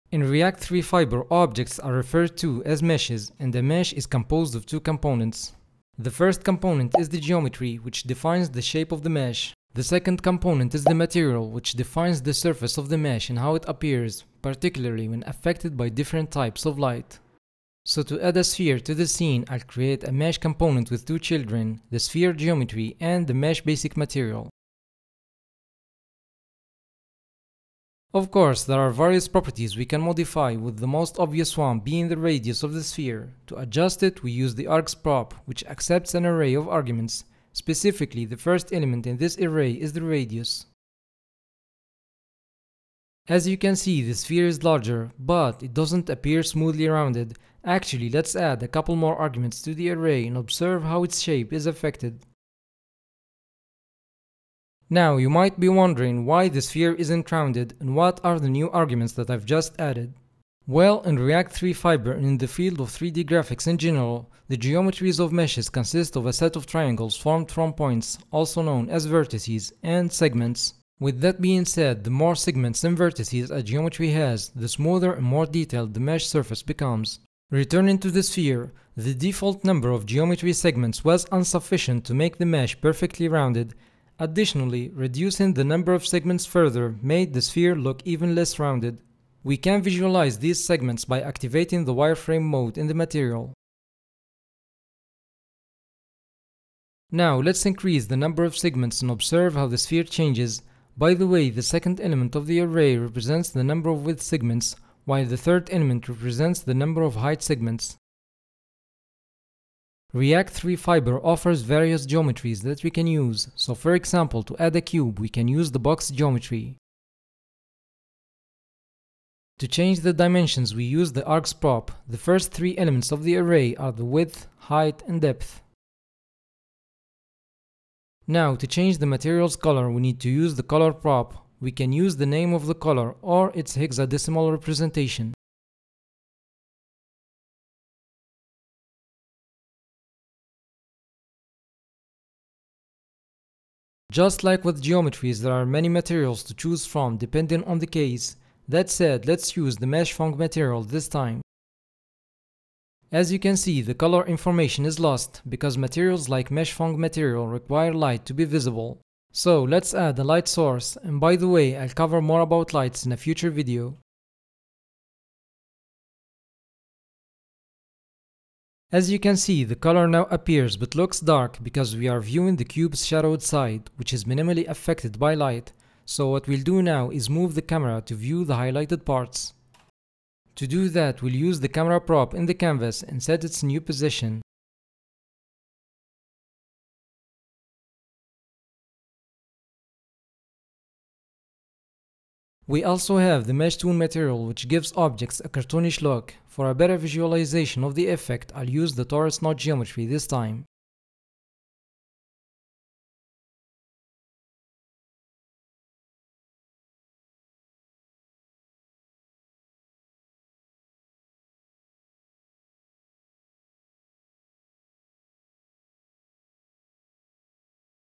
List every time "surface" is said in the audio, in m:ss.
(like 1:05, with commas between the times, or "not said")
0:12, 1:16.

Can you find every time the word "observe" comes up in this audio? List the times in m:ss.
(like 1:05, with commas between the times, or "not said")
0:50, 1:39.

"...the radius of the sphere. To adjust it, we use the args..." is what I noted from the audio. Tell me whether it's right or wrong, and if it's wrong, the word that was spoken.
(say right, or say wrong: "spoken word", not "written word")
right.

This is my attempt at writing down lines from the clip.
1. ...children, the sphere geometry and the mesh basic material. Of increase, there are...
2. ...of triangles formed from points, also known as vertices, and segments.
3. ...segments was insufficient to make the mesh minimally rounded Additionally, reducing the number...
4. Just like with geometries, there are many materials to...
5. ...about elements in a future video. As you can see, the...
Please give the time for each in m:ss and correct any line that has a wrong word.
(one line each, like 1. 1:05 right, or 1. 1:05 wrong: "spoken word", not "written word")
1. 0:21 wrong: "course", not "increase"
2. 1:06 right
3. 1:20 wrong: "perfectly", not "minimally"
4. 2:24 right
5. 2:42 wrong: "lights", not "elements".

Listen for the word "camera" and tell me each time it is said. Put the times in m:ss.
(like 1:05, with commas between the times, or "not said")
2:57, 3:01.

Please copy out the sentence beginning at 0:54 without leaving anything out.
Now you might be wondering why the sphere isn't rounded and what are the new arguments that I've just added.